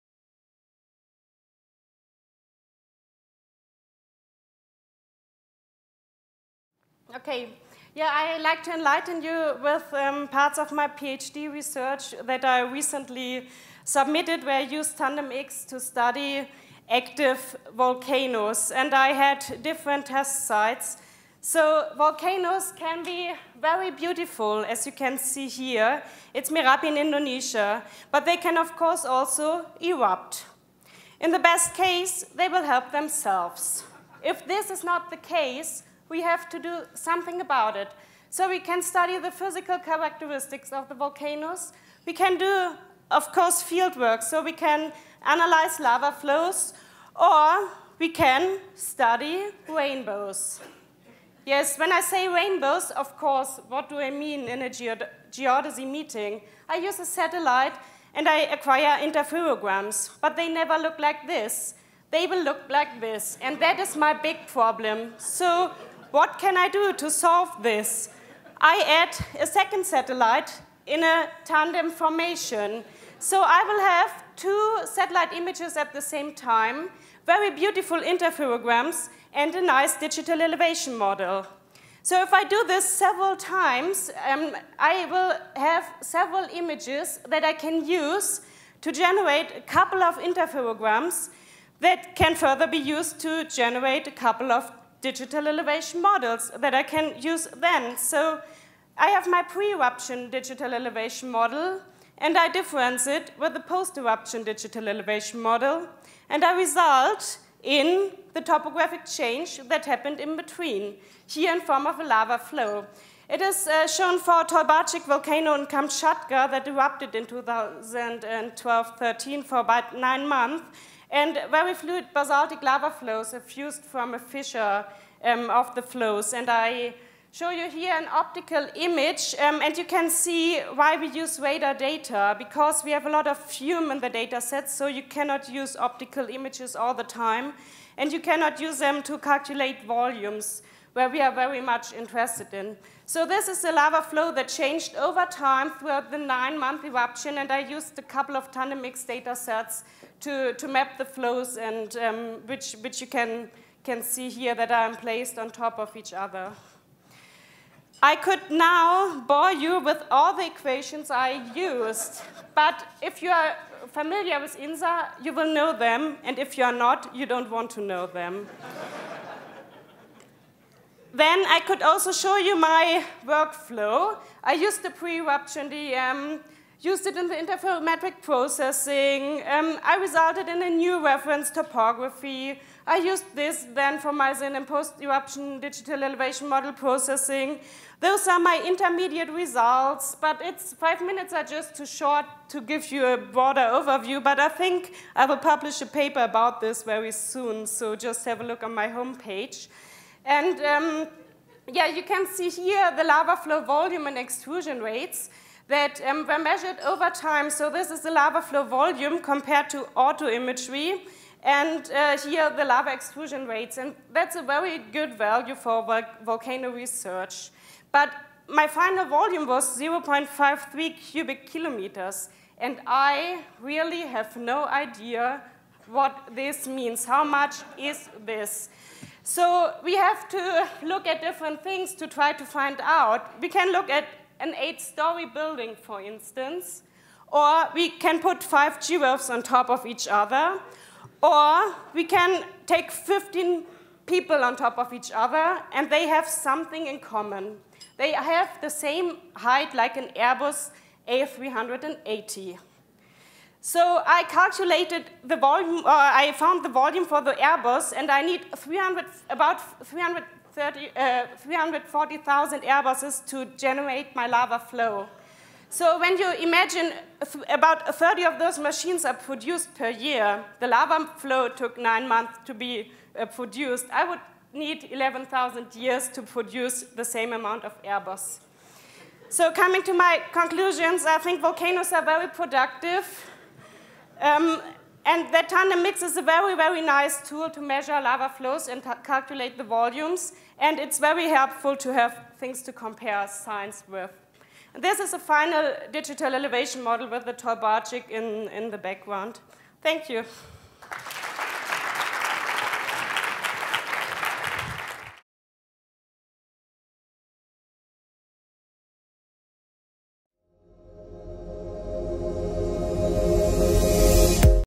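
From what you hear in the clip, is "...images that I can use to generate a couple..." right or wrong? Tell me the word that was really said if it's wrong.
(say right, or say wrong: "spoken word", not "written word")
right.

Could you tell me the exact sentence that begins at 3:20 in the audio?
And um, yeah, you can see here the lava flow volume and extrusion rates that um, were measured over time.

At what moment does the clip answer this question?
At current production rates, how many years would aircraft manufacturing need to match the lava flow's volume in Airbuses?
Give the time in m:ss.
4:34.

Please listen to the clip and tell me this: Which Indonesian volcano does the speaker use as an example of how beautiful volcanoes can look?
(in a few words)
Merapi.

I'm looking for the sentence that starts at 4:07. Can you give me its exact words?
They have the same height like an Airbus A380.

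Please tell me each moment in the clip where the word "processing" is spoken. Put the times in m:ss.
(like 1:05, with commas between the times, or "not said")
2:58, 3:06.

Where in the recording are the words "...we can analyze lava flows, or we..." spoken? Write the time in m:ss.
0:44.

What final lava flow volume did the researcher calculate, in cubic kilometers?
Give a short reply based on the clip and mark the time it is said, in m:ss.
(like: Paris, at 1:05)
0.53 cubic kilometers, at 3:39.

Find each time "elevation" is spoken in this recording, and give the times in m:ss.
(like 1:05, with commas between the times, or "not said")
1:20, 1:35, 1:40, 1:44, 3:06, 4:56.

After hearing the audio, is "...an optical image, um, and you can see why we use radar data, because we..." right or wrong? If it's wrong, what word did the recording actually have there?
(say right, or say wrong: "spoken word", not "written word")
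right.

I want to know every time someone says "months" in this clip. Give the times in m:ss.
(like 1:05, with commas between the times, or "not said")
2:00, 2:26, 4:32.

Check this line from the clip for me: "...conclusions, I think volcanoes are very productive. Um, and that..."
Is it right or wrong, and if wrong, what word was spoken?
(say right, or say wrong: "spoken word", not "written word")
right.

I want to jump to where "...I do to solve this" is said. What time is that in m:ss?
1:06.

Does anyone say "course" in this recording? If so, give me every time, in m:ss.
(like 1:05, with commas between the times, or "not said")
0:28, 0:43, 0:53.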